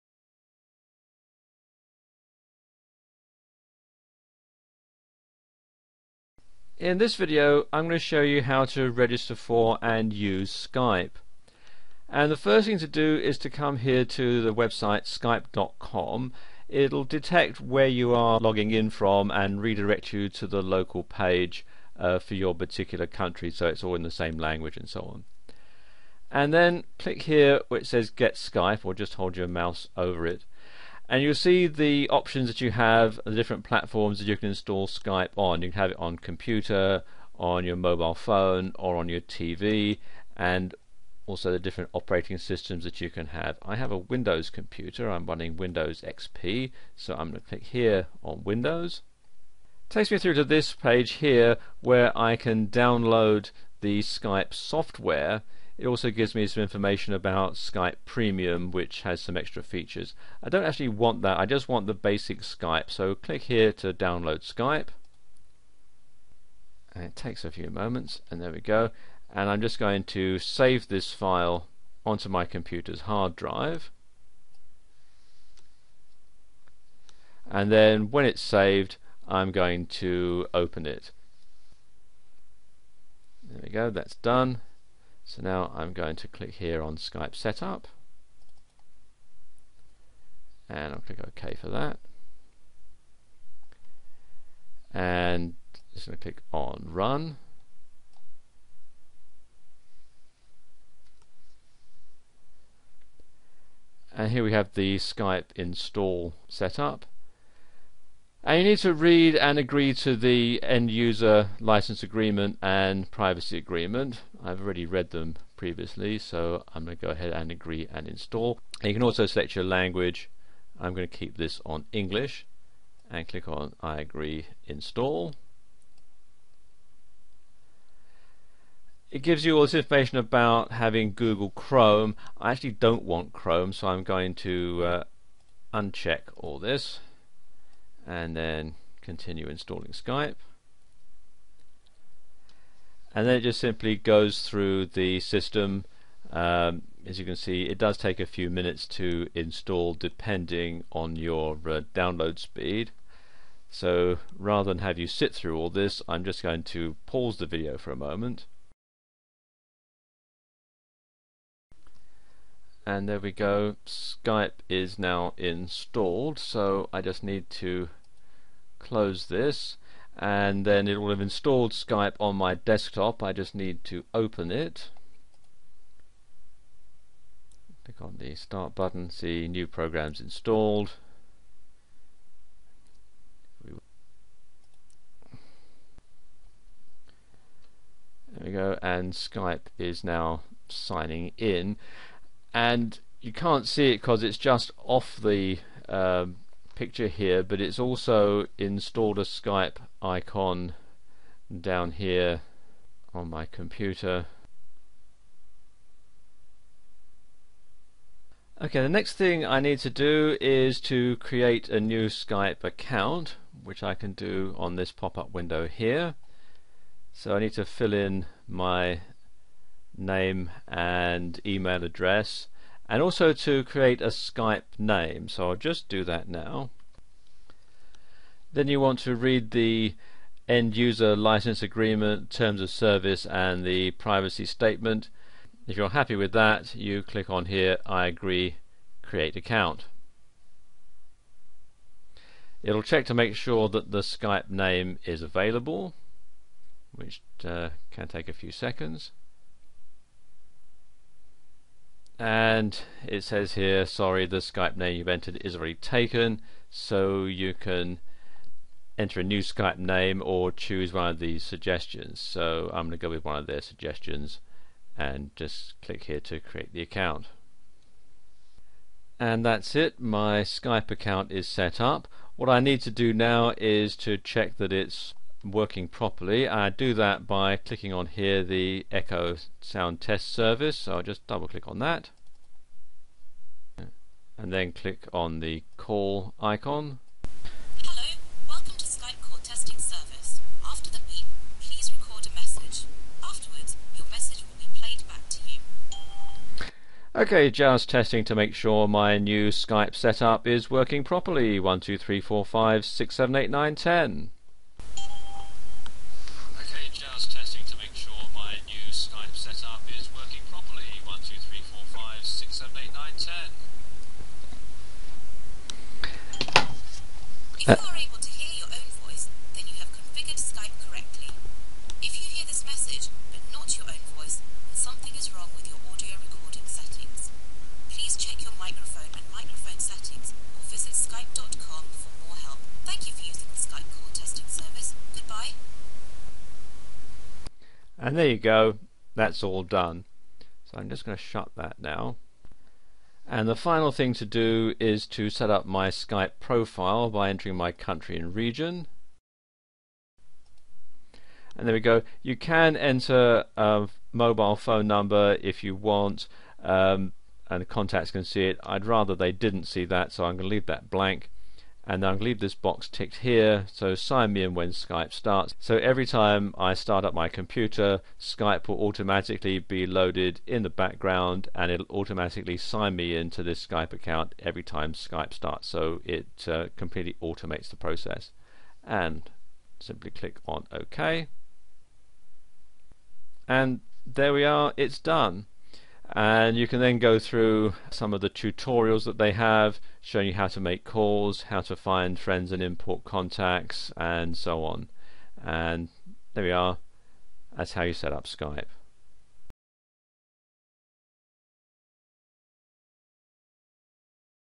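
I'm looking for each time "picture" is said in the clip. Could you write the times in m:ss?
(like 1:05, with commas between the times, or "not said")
3:16.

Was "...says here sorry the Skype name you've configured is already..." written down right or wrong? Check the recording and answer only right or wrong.
wrong.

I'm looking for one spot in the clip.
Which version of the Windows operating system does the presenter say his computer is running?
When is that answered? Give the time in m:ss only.
0:45.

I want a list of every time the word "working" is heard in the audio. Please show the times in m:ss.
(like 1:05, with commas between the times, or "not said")
4:35, 5:00.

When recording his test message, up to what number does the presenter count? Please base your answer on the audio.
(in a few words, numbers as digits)
10.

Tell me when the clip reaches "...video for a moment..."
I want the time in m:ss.
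2:37.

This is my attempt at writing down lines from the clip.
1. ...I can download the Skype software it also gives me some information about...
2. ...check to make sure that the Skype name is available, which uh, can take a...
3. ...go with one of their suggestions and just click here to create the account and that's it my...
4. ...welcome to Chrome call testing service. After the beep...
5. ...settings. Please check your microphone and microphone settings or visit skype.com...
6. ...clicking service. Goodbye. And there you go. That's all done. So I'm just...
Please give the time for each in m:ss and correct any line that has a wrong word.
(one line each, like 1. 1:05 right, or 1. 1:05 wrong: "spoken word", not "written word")
1. 0:52 right
2. 4:02 right
3. 4:22 right
4. 4:48 wrong: "Skype", not "Chrome"
5. 5:26 right
6. 5:34 wrong: "testing", not "clicking".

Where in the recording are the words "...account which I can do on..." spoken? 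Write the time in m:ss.
3:32.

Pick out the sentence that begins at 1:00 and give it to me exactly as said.
I don't actually want that, I just want the basic Skype.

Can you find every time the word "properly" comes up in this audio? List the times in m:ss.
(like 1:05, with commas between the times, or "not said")
4:35, 5:01.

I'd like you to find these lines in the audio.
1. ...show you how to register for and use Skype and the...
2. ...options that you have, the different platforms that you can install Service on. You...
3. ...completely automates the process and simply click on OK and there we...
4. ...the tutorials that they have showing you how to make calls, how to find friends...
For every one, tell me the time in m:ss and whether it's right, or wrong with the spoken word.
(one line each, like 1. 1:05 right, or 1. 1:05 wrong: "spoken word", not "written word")
1. 0:07 right
2. 0:32 wrong: "Skype", not "Service"
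3. 6:16 right
4. 6:28 right.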